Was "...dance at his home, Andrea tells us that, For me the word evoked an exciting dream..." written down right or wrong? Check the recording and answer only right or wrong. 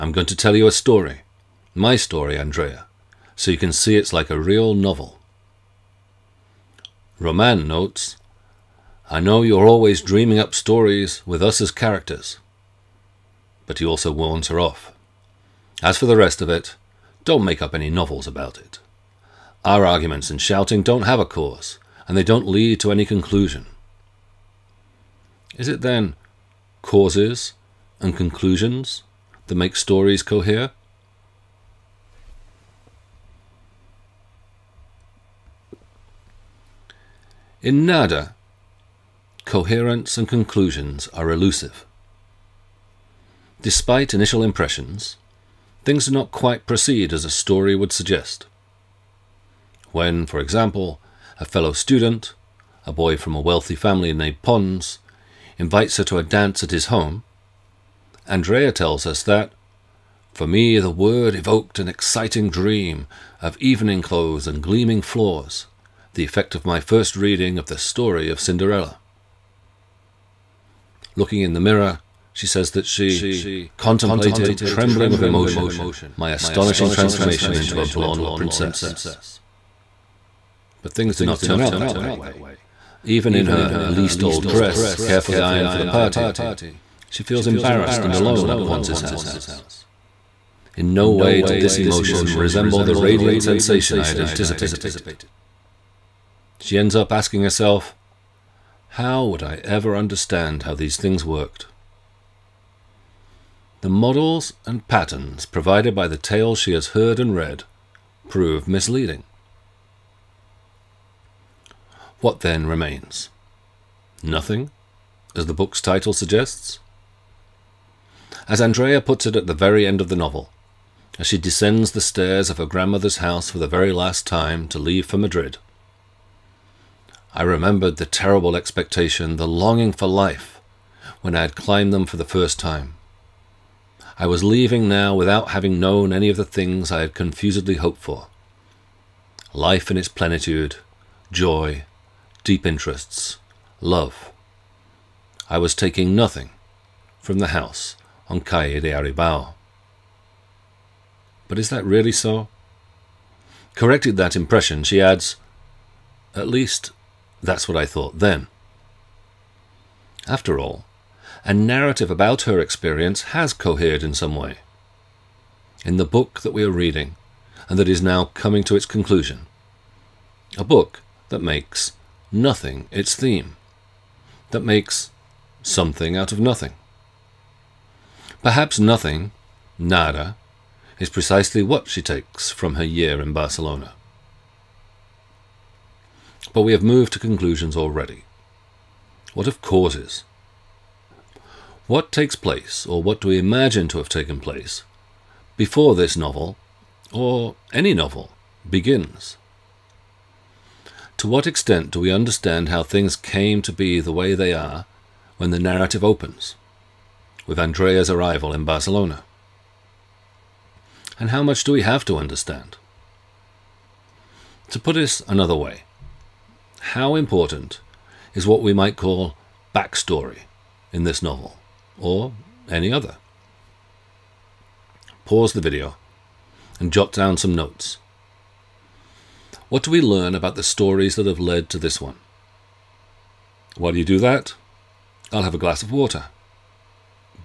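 right.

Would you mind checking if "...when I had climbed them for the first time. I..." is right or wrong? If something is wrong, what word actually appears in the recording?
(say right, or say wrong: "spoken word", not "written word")
right.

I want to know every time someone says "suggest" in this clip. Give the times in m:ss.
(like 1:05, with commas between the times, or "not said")
0:47, 1:56.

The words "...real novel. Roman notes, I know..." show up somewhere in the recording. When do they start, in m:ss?
0:04.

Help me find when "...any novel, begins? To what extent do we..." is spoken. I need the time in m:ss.
3:17.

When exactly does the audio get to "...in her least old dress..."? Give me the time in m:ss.
1:23.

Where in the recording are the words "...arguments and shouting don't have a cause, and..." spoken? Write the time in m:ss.
0:19.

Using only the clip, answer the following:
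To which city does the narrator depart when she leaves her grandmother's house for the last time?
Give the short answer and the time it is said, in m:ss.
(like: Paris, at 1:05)
Madrid, at 2:05.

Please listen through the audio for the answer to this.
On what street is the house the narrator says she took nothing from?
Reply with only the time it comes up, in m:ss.
2:28.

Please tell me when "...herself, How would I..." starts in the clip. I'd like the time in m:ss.
1:37.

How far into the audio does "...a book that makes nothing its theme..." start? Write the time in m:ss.
2:50.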